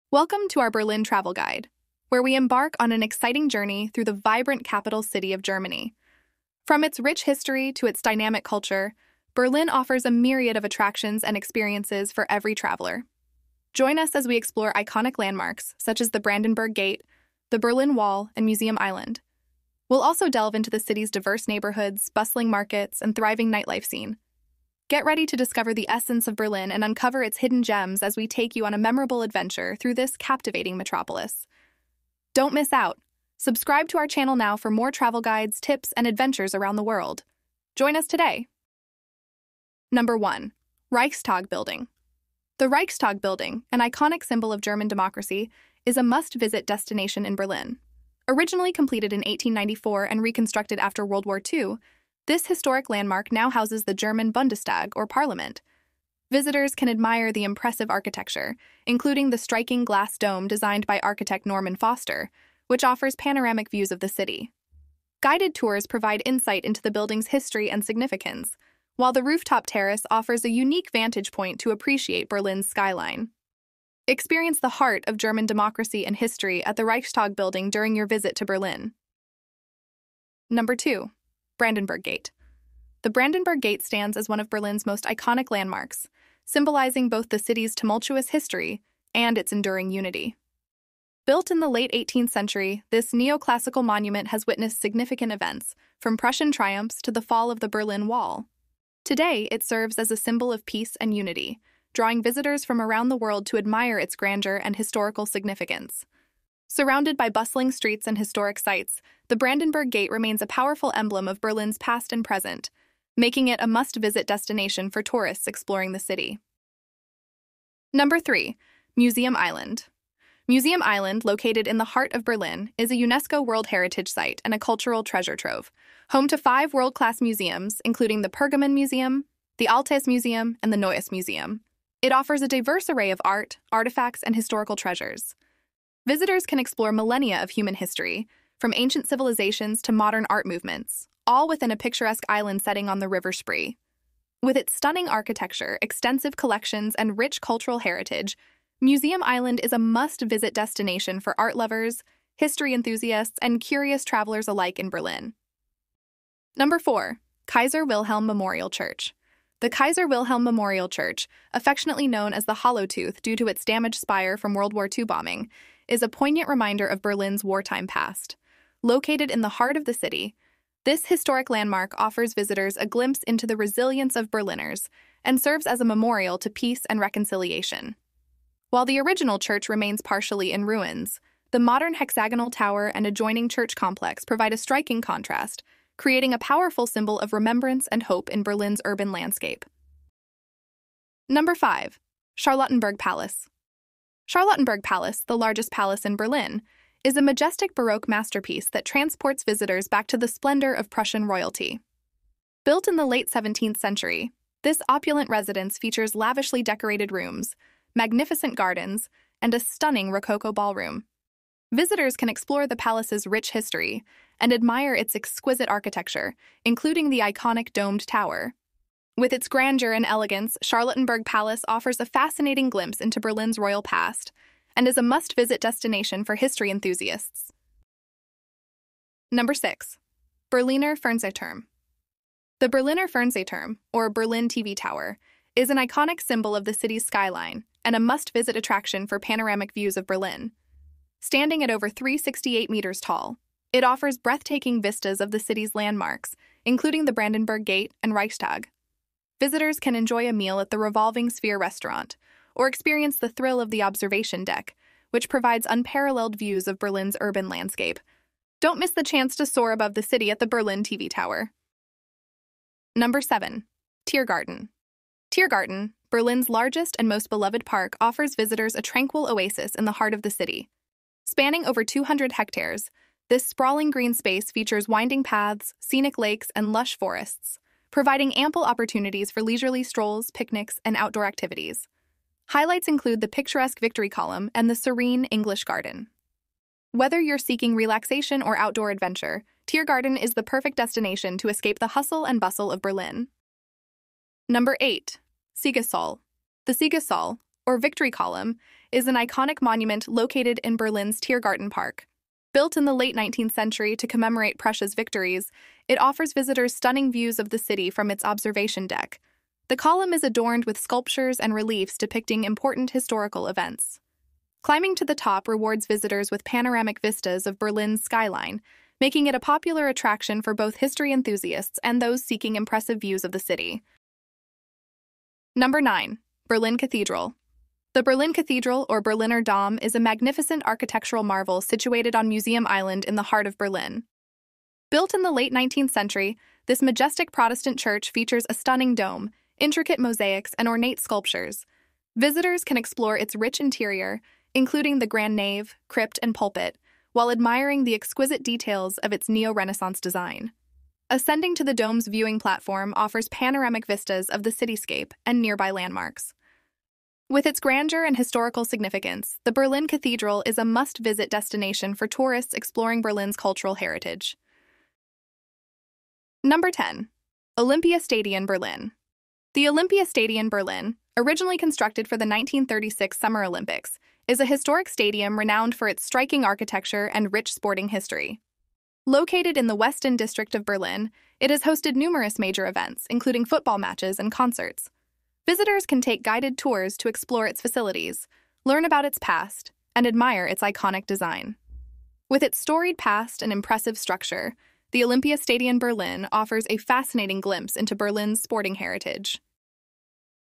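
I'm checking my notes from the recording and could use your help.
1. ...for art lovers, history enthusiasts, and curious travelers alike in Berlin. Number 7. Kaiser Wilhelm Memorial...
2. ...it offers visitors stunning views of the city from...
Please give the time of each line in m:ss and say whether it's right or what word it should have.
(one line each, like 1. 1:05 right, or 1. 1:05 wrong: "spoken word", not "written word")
1. 2:31 wrong: "4", not "7"
2. 5:05 right.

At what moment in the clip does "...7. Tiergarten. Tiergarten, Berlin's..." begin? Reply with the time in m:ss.
4:23.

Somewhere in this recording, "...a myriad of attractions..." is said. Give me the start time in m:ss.
0:10.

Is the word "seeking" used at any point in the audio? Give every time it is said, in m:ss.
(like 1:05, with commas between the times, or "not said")
4:47, 5:22.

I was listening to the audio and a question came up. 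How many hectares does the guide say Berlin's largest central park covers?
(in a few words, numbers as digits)
over 200.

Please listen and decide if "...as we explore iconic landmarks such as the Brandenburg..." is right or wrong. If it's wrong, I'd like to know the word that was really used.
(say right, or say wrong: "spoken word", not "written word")
right.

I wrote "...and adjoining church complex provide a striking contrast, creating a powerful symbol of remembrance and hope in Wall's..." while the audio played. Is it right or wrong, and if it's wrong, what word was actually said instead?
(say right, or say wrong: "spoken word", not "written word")
wrong: "Berlin", not "Wall".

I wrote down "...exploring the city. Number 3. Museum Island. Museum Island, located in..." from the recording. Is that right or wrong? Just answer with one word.
right.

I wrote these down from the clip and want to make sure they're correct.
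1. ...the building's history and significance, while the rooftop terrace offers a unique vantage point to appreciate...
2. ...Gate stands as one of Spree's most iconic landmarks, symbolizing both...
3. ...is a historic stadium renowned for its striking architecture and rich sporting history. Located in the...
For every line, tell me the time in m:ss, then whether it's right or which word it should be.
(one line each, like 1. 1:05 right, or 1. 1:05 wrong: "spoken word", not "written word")
1. 1:06 right
2. 1:23 wrong: "Berlin", not "Spree"
3. 6:14 right.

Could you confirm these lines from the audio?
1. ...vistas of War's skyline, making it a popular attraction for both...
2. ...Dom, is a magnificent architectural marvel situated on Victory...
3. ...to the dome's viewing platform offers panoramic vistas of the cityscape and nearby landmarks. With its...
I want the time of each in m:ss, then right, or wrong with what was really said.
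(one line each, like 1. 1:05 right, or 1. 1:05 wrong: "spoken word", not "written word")
1. 5:17 wrong: "Berlin", not "War"
2. 5:29 wrong: "Museum", not "Victory"
3. 5:51 right.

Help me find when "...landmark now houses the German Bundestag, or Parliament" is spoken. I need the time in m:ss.
0:52.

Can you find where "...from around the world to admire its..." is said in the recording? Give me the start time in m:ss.
1:42.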